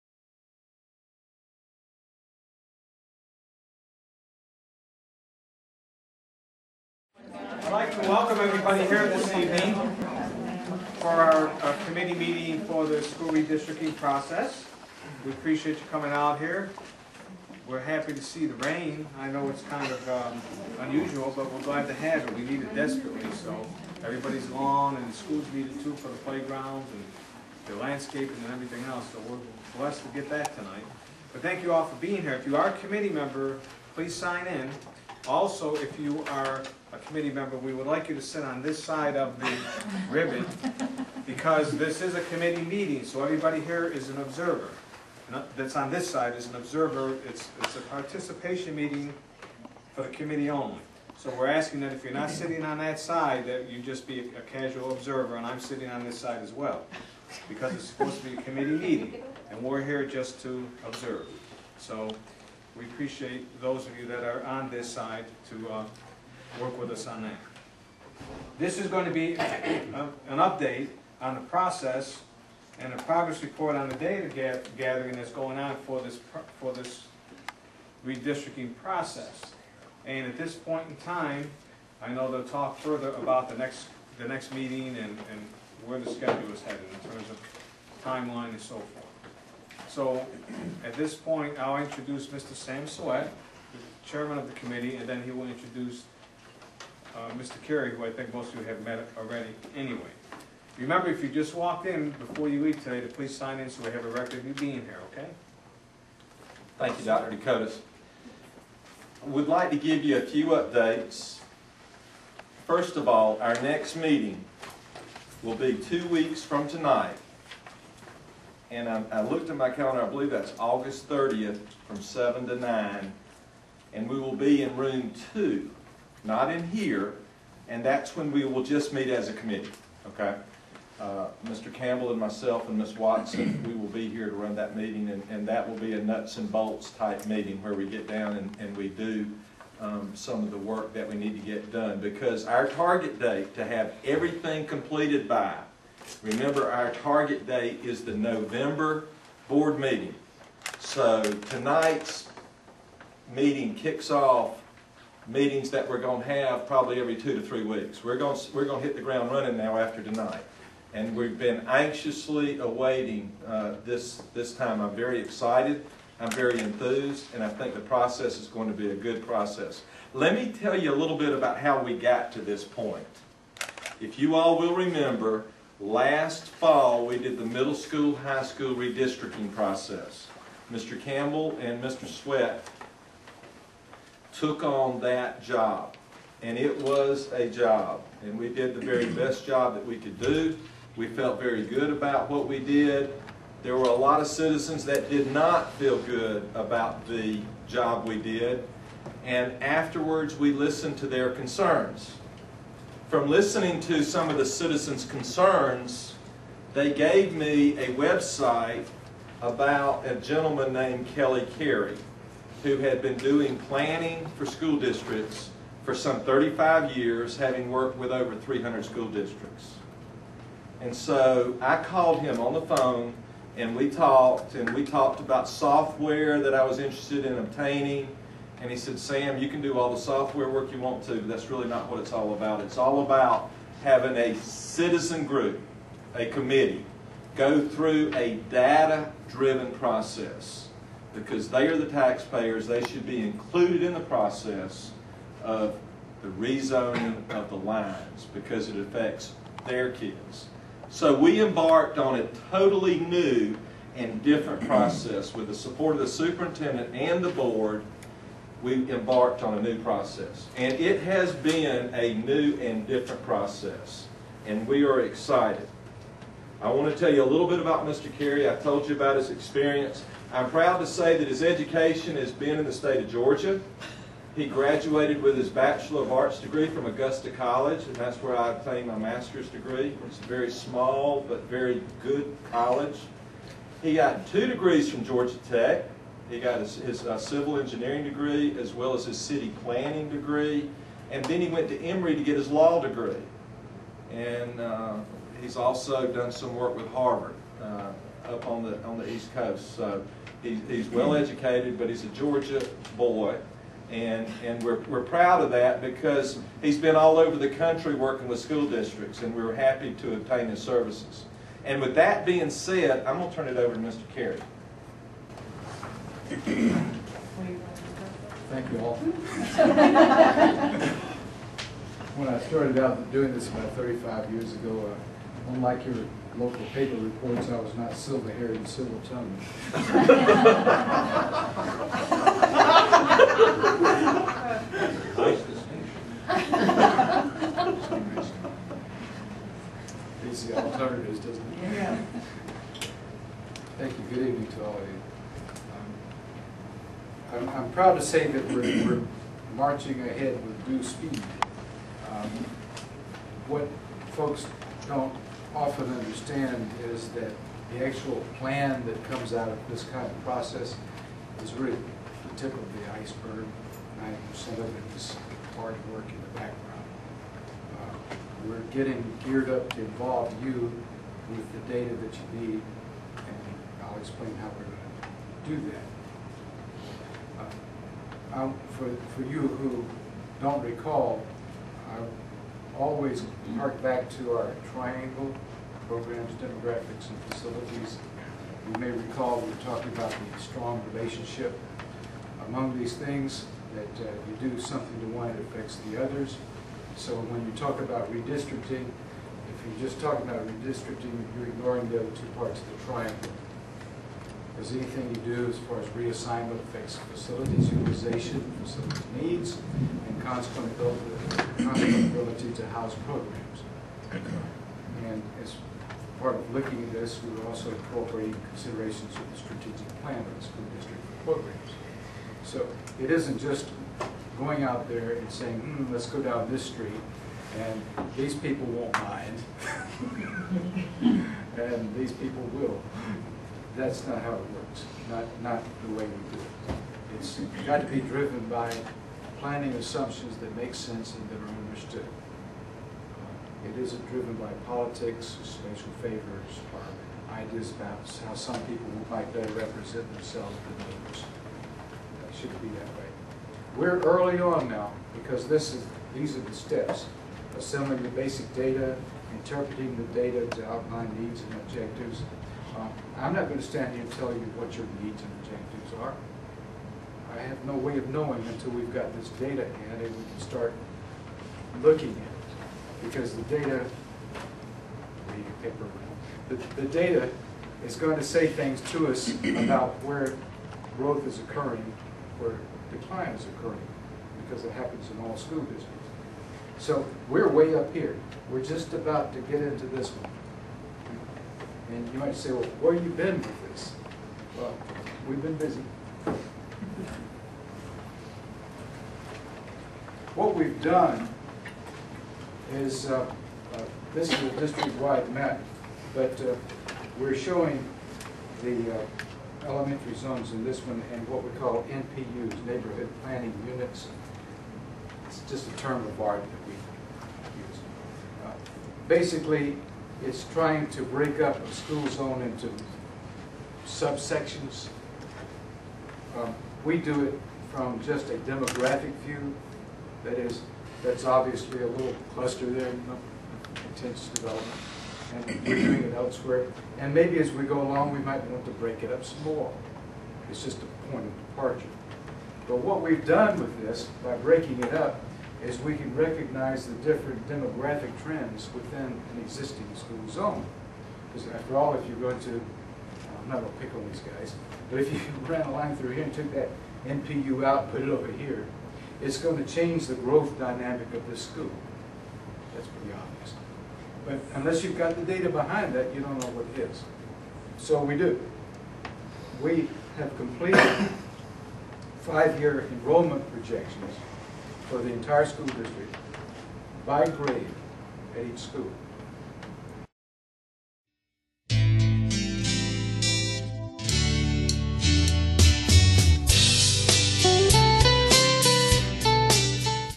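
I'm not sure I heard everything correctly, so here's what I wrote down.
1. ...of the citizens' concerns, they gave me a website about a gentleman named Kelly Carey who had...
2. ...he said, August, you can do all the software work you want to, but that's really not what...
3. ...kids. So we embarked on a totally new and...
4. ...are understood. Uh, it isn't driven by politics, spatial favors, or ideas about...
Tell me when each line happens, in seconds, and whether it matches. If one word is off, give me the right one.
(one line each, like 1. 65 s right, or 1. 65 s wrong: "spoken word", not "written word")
1. 204 s right
2. 228 s wrong: "Sam", not "August"
3. 249 s right
4. 441 s right.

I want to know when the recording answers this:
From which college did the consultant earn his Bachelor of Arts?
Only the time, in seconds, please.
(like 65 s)
276 s.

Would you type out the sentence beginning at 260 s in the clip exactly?
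And it has been a new and different process.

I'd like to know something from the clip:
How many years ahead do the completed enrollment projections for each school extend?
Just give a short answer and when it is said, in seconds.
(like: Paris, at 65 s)
5, at 572 s.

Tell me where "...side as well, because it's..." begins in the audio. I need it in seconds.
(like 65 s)
56 s.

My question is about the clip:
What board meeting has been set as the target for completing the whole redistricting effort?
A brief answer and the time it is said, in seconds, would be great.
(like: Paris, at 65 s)
November board meeting, at 148 s.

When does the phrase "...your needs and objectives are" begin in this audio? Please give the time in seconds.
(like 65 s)
464 s.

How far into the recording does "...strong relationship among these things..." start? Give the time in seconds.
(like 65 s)
390 s.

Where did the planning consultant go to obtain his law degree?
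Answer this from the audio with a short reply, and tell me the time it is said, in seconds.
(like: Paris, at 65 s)
Emory, at 291 s.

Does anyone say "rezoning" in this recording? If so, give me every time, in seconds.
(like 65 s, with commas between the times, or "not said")
246 s.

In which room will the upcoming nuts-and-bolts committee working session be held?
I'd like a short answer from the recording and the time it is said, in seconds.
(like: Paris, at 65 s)
Room 2, at 124 s.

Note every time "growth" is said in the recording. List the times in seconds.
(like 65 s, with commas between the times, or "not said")
480 s, 560 s.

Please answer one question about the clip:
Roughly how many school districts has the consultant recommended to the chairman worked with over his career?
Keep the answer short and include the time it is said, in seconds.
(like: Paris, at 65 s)
300, at 218 s.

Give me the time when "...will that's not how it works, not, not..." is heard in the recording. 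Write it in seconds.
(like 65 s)
432 s.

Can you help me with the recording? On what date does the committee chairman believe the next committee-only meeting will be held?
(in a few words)
August 30th.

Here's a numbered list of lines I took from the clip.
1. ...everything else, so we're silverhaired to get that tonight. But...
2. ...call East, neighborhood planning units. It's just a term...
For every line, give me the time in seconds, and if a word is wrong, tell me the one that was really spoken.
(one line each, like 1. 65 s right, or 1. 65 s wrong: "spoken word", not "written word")
1. 28 s wrong: "blessed", not "silverhaired"
2. 511 s wrong: "NPUs", not "East".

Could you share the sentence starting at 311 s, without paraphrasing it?
And with that being said, I'm going to turn it over to Mr.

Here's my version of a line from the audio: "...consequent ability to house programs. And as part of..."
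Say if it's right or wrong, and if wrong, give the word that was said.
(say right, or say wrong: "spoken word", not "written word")
right.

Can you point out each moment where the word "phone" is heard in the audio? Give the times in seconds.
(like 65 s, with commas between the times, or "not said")
222 s.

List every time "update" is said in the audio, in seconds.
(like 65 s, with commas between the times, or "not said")
70 s, 110 s.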